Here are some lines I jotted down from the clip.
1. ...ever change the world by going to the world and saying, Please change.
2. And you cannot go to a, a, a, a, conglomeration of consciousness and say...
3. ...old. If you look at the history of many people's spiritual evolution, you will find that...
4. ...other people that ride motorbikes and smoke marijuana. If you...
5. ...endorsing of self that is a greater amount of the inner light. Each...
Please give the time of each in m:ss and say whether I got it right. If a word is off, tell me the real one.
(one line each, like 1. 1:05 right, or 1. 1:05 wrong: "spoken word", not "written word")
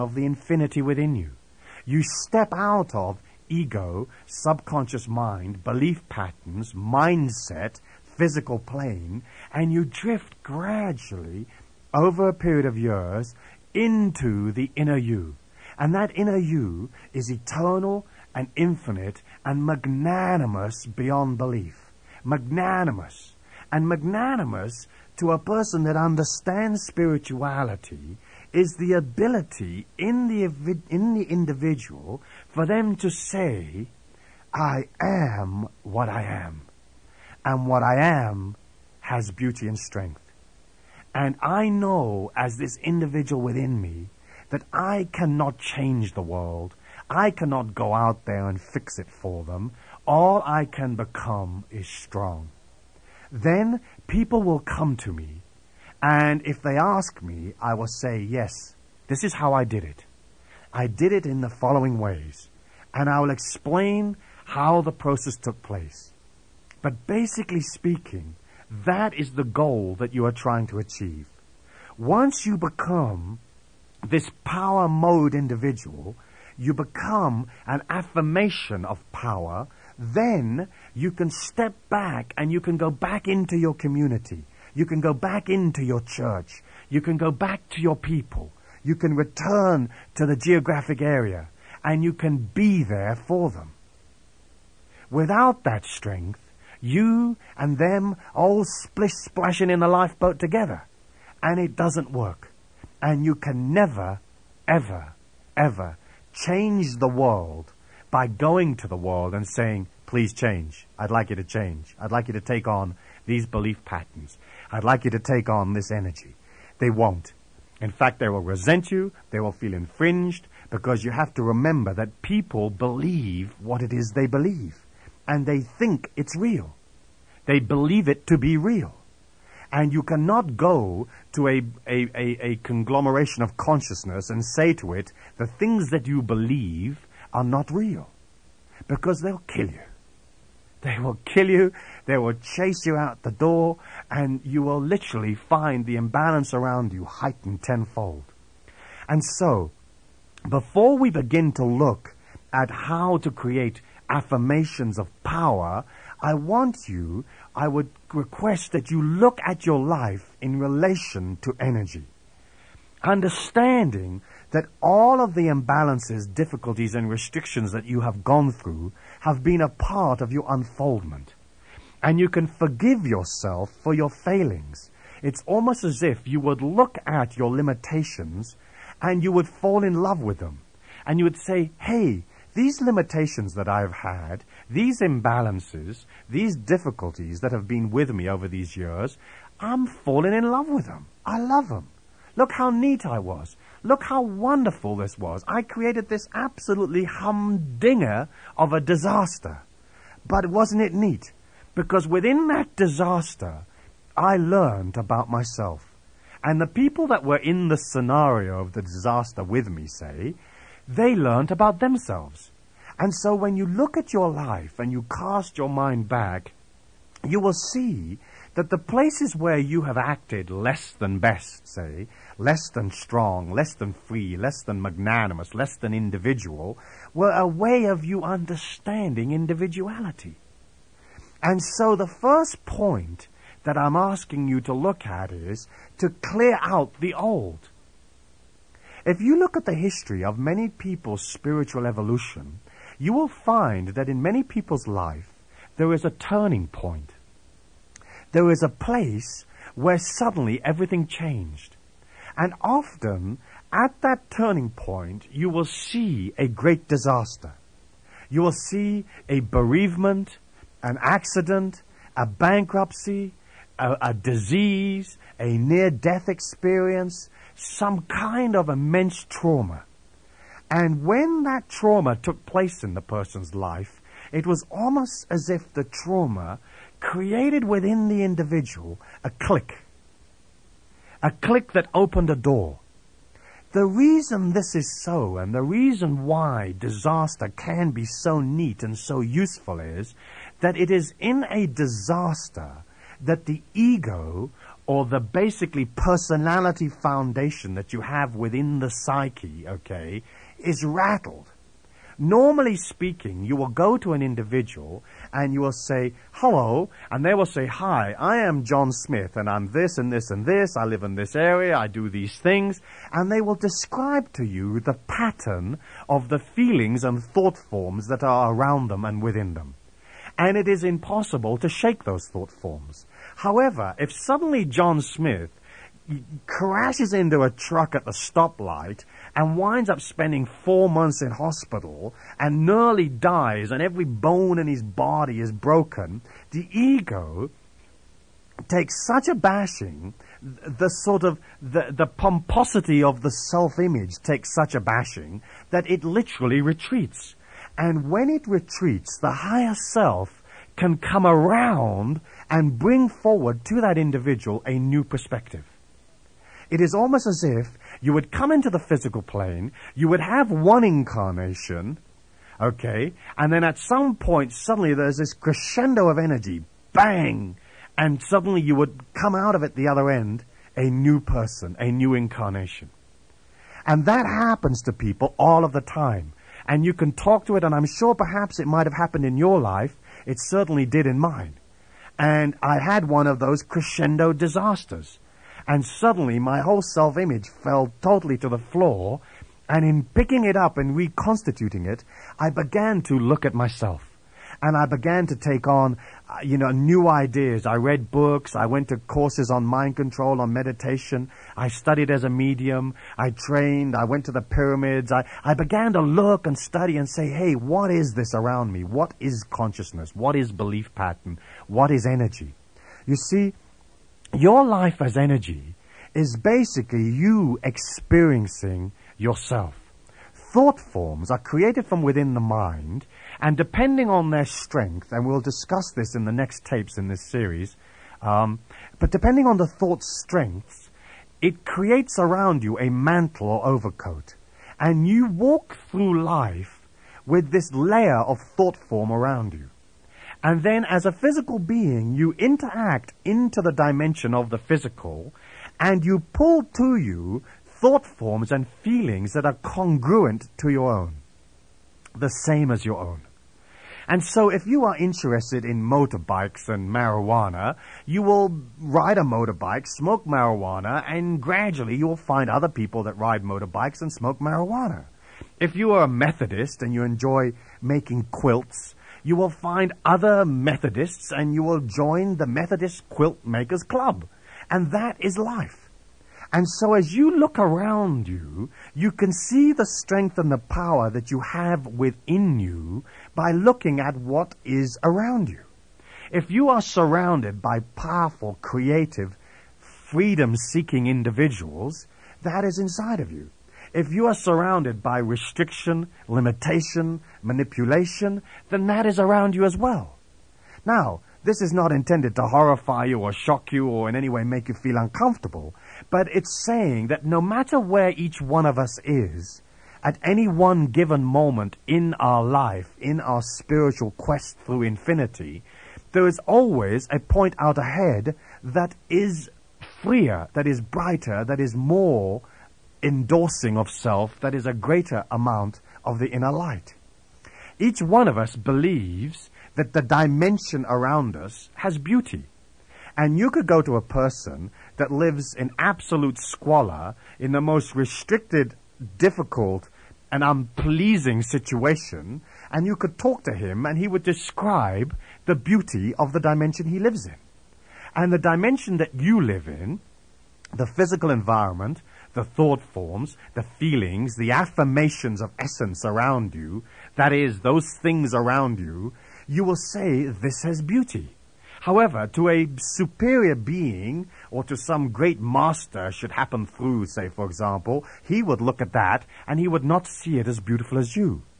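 1. 1:45 right
2. 2:09 right
3. 3:57 right
4. 7:42 right
5. 8:43 right.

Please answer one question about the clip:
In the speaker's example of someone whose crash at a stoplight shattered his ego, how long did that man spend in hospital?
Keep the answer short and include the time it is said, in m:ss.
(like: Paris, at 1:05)
4 months, at 5:30.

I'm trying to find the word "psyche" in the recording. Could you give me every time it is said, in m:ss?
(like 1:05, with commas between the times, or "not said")
4:58.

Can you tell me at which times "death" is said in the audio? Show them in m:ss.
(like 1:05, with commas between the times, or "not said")
4:25.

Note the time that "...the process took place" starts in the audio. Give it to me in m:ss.
1:04.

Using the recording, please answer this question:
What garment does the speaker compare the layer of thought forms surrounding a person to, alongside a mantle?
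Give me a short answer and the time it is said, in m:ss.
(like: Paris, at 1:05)
Overcoat, at 7:13.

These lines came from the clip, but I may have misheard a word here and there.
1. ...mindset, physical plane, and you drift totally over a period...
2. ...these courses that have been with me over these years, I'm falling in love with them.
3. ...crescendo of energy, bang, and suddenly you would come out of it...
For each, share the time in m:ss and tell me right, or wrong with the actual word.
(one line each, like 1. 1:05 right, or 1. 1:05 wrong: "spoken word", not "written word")
1. 0:06 wrong: "gradually", not "totally"
2. 3:06 wrong: "difficulties", not "courses"
3. 6:05 right.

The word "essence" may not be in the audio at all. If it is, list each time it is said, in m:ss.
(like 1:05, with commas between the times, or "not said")
9:15.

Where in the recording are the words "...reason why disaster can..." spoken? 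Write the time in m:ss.
4:45.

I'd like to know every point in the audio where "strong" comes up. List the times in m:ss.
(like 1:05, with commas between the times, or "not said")
0:51, 3:42.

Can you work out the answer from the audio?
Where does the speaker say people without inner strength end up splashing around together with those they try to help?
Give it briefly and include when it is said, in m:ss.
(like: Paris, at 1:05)
In the lifeboat, at 1:39.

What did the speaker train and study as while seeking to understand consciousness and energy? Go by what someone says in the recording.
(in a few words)
A medium.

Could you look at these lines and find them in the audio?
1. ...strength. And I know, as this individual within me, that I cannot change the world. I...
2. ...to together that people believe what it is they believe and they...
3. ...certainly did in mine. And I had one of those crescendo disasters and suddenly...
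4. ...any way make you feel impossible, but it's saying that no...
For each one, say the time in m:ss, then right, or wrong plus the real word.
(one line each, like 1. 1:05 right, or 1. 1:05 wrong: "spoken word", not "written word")
1. 0:39 right
2. 2:01 wrong: "remember", not "together"
3. 6:20 right
4. 8:24 wrong: "uncomfortable", not "impossible".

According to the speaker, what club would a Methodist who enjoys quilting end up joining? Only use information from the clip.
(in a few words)
Methodist Quilt Makers Club.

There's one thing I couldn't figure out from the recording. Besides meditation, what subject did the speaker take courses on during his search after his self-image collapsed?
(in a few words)
Mind control.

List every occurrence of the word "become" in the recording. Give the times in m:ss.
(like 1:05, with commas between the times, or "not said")
0:50, 1:12, 1:16.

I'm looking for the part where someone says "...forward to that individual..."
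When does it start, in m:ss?
5:53.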